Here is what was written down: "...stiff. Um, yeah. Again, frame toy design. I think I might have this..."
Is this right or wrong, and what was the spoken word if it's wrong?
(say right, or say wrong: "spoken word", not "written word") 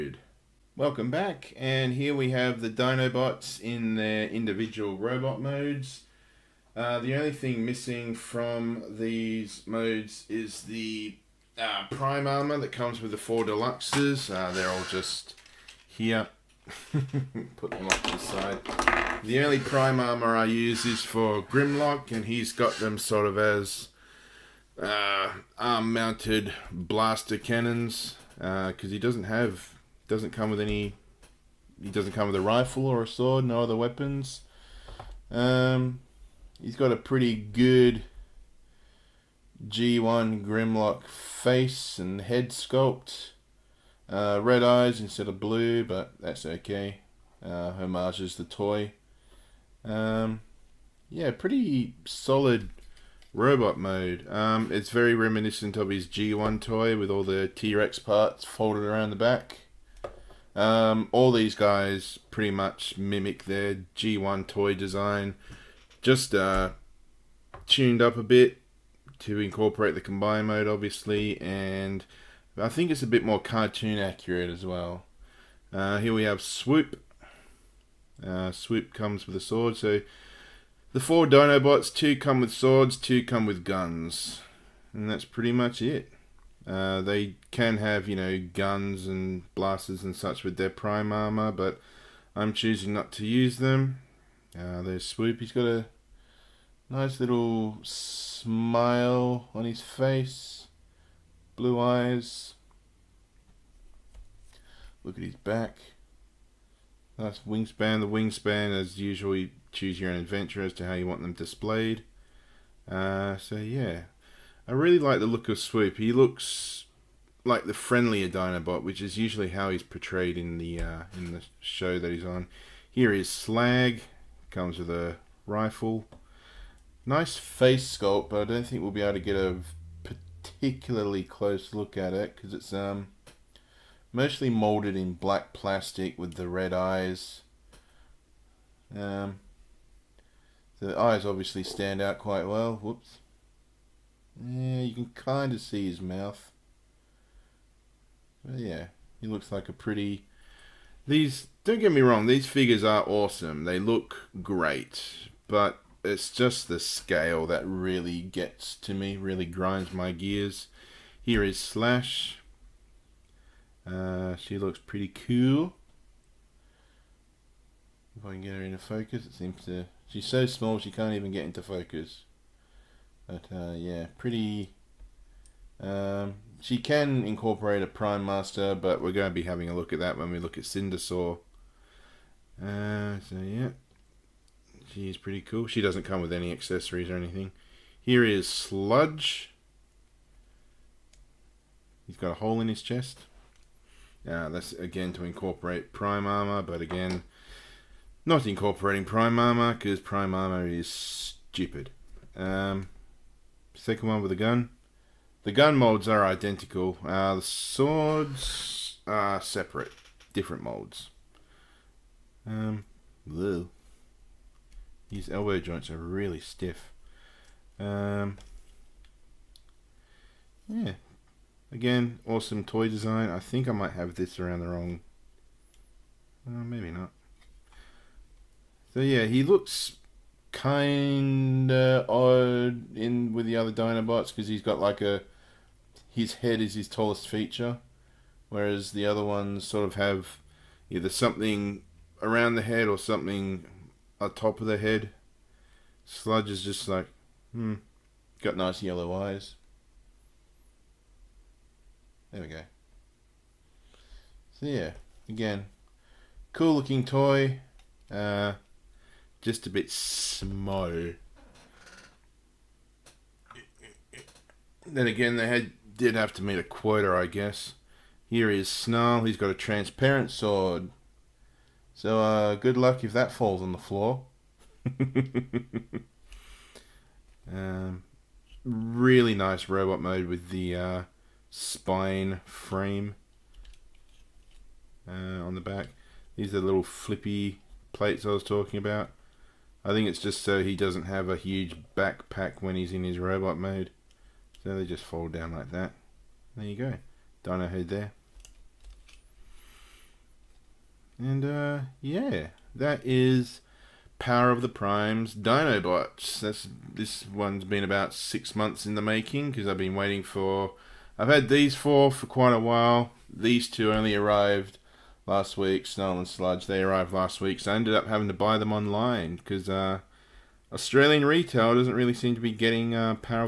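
wrong: "awesome", not "frame".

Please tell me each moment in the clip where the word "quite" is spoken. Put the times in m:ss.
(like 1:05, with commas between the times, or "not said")
2:22, 5:12.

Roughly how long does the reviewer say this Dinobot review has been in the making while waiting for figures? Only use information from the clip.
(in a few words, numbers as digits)
About 6 months.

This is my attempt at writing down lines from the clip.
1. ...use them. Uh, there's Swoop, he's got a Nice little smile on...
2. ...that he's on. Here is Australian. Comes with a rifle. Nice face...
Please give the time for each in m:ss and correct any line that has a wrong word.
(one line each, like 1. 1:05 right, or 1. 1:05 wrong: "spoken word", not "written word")
1. 1:33 right
2. 2:02 wrong: "Slag", not "Australian".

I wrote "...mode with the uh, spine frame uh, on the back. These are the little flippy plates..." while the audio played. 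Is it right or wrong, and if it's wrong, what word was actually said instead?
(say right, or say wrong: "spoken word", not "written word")
right.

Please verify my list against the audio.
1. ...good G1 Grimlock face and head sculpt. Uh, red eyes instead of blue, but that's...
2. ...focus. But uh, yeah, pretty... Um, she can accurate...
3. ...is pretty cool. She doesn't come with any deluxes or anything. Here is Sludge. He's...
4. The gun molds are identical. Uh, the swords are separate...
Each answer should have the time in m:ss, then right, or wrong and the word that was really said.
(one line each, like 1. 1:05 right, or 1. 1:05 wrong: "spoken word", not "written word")
1. 0:37 right
2. 2:51 wrong: "incorporate", not "accurate"
3. 3:05 wrong: "accessories", not "deluxes"
4. 3:25 right.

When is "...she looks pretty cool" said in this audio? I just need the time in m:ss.
2:44.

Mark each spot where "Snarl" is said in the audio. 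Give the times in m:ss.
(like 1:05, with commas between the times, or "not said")
4:28, 5:15.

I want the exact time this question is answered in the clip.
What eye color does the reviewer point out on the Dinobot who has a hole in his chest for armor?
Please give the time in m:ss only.
4:08.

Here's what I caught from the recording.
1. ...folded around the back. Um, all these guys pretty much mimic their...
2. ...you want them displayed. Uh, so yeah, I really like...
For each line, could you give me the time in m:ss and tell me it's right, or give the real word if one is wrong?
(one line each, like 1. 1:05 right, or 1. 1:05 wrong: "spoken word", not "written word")
1. 0:58 right
2. 1:50 right.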